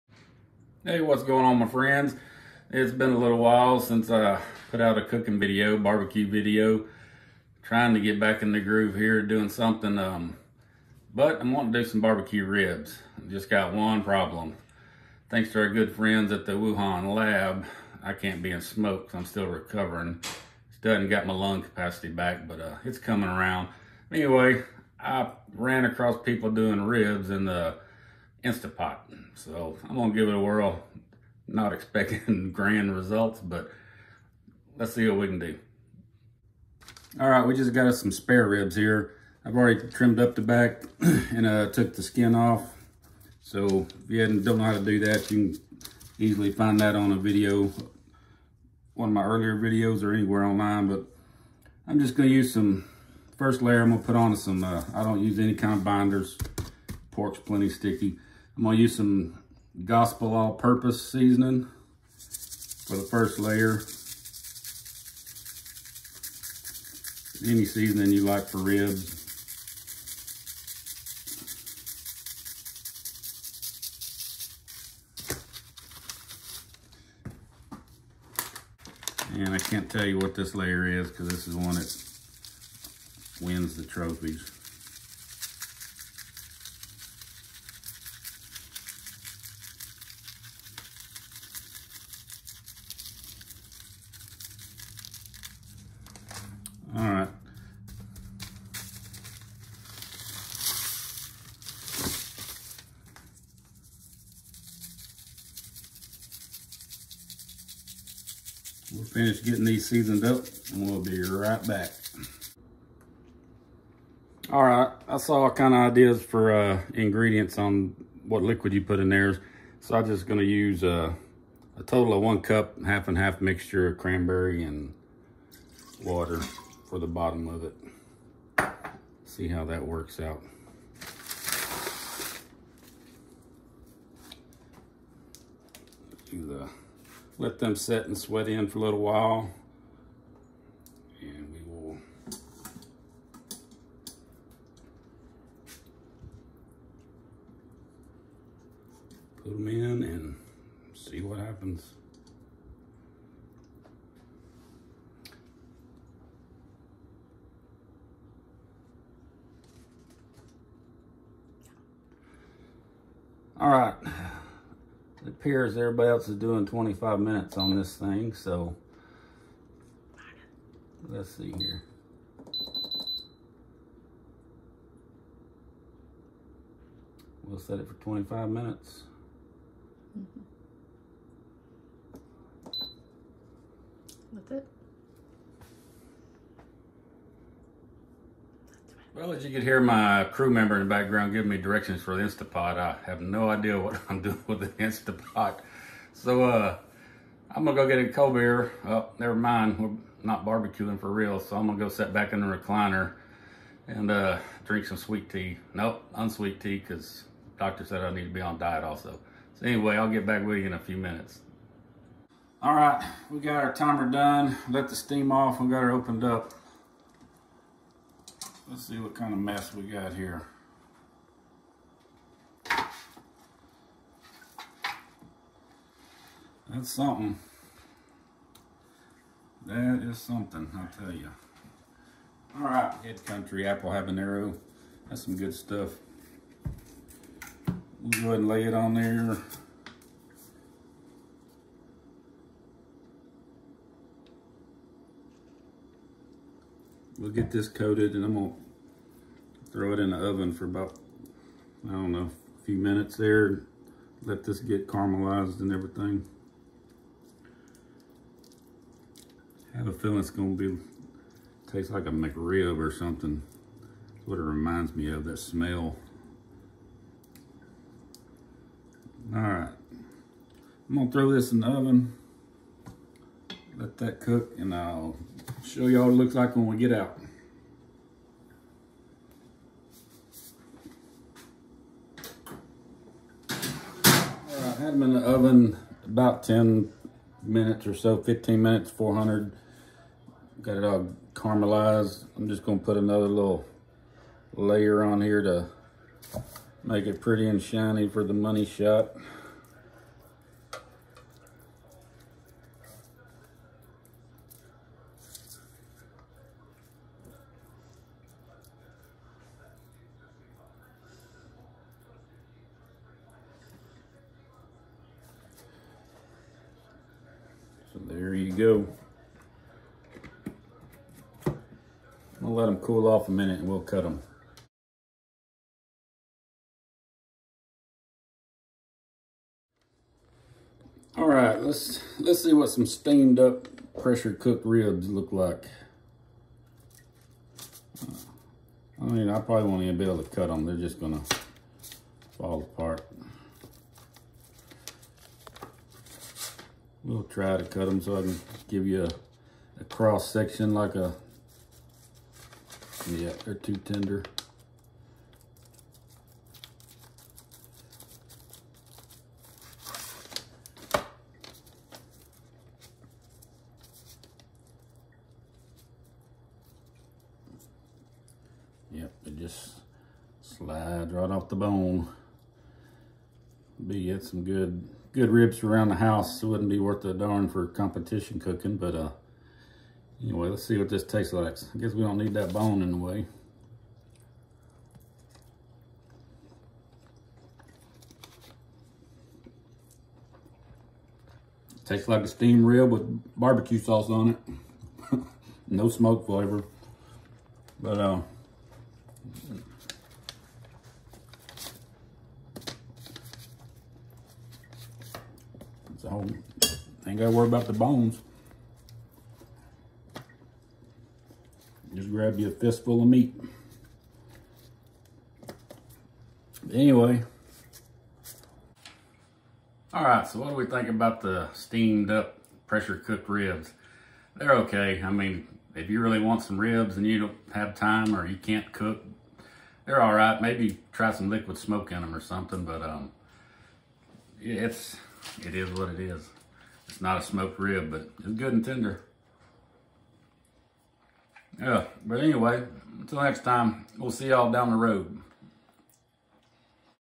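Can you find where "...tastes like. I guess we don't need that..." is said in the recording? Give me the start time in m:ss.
6:21.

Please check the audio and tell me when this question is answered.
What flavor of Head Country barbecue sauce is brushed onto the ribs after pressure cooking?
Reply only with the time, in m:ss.
3:53.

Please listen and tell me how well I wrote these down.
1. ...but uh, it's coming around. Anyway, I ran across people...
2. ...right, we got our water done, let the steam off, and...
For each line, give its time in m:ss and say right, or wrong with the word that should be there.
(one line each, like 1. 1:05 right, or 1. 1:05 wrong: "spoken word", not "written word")
1. 0:22 right
2. 3:32 wrong: "timer", not "water".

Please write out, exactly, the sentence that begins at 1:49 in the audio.
finish getting these seasoned up and we'll be right back.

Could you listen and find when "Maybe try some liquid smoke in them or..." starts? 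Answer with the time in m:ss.
7:10.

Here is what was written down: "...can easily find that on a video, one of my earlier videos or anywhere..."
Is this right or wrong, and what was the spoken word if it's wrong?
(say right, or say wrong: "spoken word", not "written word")
right.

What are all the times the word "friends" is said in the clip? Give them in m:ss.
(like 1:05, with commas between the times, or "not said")
0:01, 0:15.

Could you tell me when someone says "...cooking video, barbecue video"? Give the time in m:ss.
0:05.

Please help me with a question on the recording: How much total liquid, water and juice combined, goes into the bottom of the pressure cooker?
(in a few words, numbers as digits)
one cup.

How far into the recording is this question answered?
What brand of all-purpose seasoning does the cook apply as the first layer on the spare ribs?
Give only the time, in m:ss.
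0:59.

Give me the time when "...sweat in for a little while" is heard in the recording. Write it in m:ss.
2:18.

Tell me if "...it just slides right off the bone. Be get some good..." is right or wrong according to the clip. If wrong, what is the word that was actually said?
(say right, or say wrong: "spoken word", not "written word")
right.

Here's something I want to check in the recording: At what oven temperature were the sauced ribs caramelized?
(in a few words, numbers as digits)
400.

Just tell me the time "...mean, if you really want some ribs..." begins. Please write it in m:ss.
7:05.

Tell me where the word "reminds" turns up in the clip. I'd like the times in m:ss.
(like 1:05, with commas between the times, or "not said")
4:24.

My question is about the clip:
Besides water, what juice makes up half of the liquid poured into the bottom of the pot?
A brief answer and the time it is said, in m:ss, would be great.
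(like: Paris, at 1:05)
cranberry, at 2:03.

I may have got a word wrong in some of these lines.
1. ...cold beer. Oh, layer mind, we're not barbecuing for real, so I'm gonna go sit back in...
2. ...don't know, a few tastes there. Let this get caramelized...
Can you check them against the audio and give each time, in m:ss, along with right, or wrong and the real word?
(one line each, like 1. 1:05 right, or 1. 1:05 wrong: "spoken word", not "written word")
1. 3:18 wrong: "never", not "layer"
2. 4:11 wrong: "minutes", not "tastes".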